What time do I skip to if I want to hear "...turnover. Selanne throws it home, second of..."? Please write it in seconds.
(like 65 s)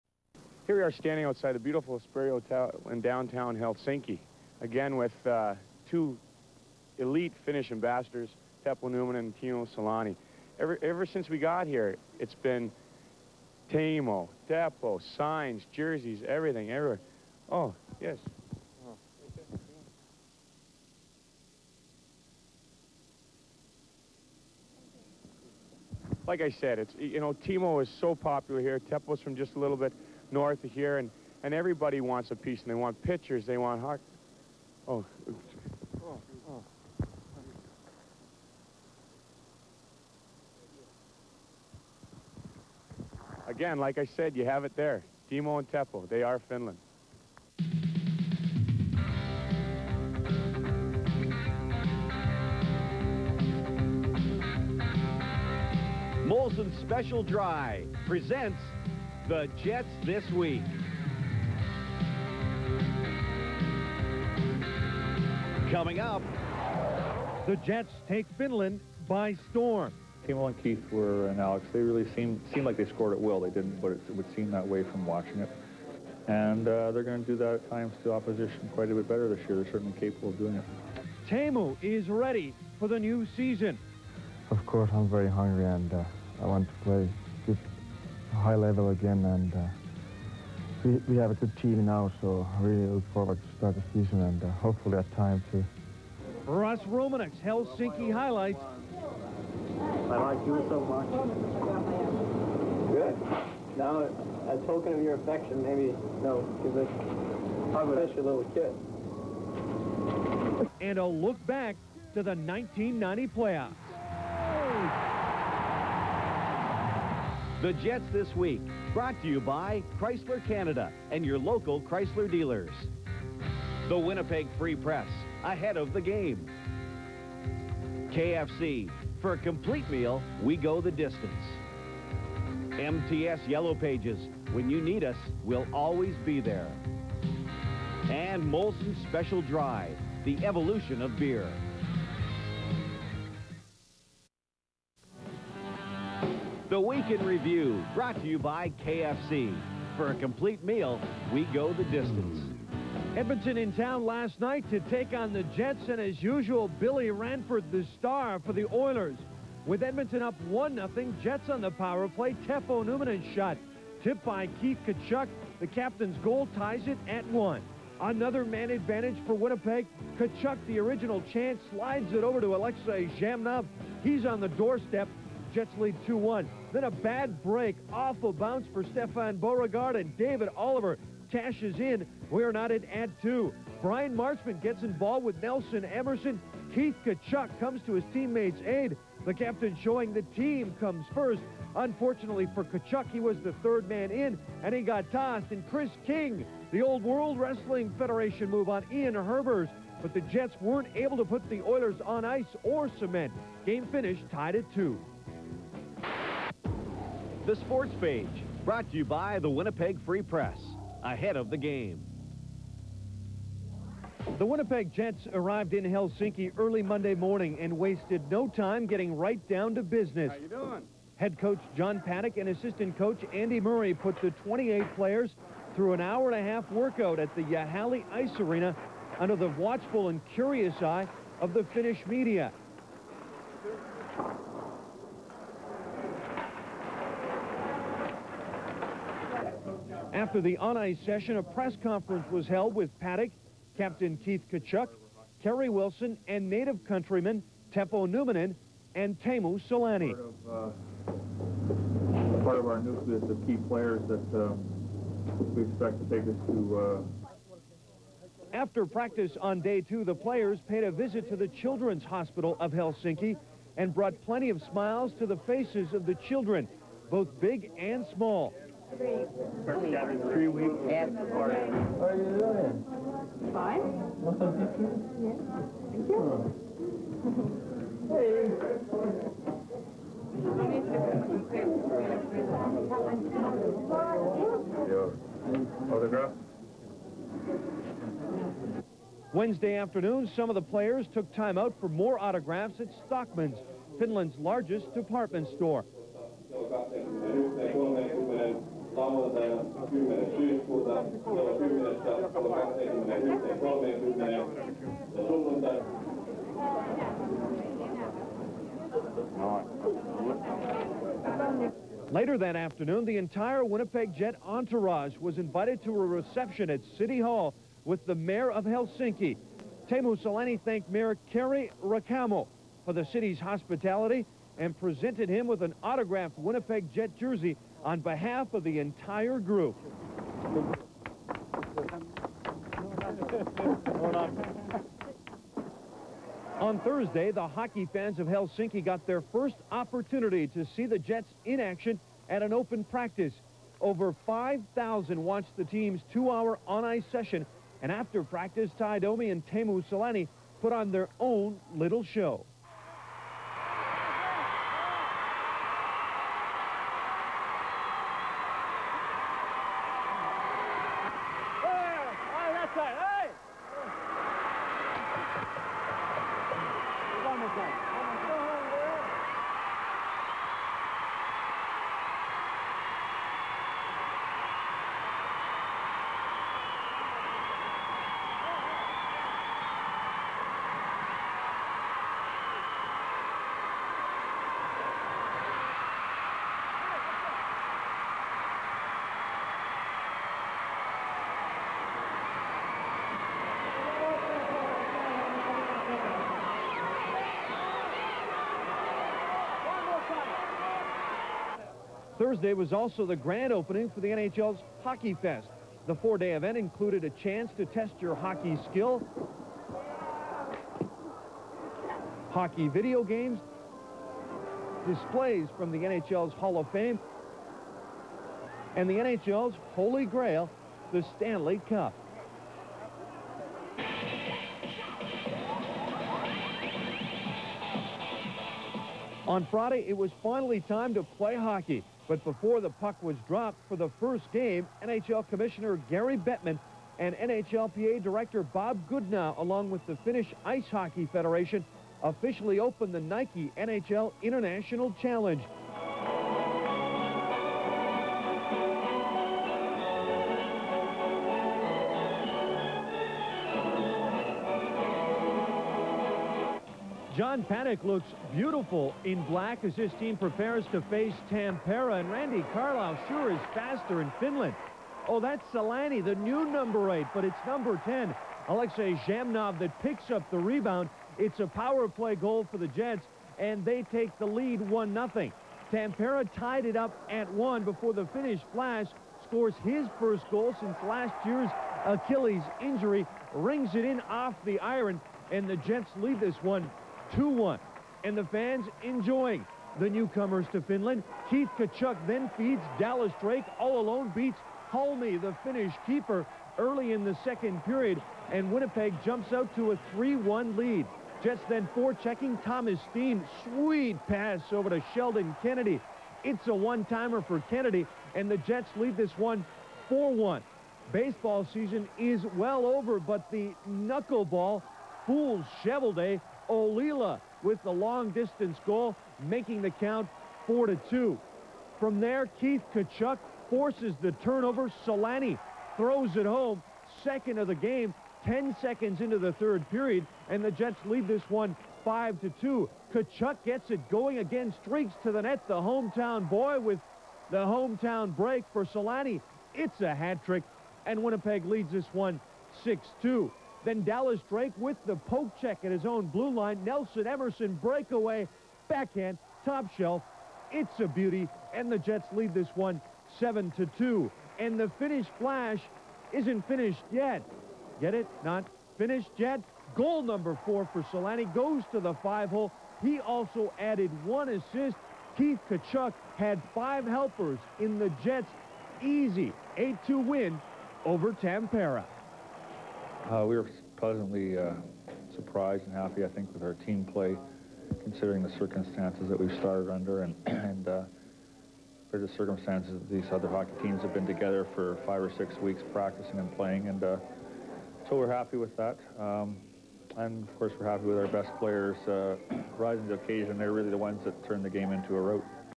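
524 s.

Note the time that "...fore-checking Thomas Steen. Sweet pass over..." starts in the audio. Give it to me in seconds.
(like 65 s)
501 s.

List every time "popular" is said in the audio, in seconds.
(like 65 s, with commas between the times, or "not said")
28 s.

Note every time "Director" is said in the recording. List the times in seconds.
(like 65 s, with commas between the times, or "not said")
438 s.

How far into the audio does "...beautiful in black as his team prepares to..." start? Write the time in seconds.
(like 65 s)
458 s.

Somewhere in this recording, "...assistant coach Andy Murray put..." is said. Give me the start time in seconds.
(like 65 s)
222 s.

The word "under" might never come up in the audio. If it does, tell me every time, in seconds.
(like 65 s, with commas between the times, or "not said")
229 s, 579 s.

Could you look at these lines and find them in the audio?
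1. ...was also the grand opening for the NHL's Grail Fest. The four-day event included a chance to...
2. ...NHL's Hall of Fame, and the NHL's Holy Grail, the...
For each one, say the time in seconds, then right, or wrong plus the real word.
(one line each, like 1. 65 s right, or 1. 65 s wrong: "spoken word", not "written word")
1. 402 s wrong: "Hockey", not "Grail"
2. 415 s right.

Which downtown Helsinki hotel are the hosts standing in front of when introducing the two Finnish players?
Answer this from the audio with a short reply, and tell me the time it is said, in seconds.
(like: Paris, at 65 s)
Espero Hotel, at 1 s.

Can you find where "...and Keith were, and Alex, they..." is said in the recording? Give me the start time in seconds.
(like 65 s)
70 s.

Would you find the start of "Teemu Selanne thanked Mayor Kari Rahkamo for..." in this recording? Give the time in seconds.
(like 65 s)
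319 s.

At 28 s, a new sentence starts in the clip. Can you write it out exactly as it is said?
Teppo's from just a little bit north of here, and, and everybody wants a piece, and they want pictures, they want hot.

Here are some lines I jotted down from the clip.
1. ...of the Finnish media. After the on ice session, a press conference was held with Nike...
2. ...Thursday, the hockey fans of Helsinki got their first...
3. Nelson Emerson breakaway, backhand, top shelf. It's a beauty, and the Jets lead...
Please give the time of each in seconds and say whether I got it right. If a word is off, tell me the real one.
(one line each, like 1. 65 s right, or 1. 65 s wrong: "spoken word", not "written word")
1. 231 s wrong: "Paddock", not "Nike"
2. 336 s right
3. 546 s right.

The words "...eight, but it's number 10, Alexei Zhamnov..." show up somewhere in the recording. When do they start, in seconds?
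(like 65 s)
466 s.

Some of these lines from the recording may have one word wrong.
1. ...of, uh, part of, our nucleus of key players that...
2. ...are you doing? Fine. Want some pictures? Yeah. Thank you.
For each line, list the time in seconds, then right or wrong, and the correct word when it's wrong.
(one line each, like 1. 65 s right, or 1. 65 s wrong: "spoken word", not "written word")
1. 250 s right
2. 272 s right.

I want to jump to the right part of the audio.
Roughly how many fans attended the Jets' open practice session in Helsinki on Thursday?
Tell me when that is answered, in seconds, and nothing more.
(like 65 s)
343 s.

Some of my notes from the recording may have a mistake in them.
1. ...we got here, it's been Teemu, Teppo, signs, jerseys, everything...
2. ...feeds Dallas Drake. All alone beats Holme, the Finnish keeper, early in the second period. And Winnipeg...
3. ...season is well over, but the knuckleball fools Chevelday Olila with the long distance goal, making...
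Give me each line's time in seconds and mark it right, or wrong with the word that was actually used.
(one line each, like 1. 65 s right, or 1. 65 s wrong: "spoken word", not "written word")
1. 11 s right
2. 492 s right
3. 511 s right.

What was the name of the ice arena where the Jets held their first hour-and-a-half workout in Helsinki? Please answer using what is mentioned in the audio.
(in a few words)
Jäähalli Ice Arena.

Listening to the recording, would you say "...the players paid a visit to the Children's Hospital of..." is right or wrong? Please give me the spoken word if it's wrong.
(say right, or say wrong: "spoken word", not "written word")
right.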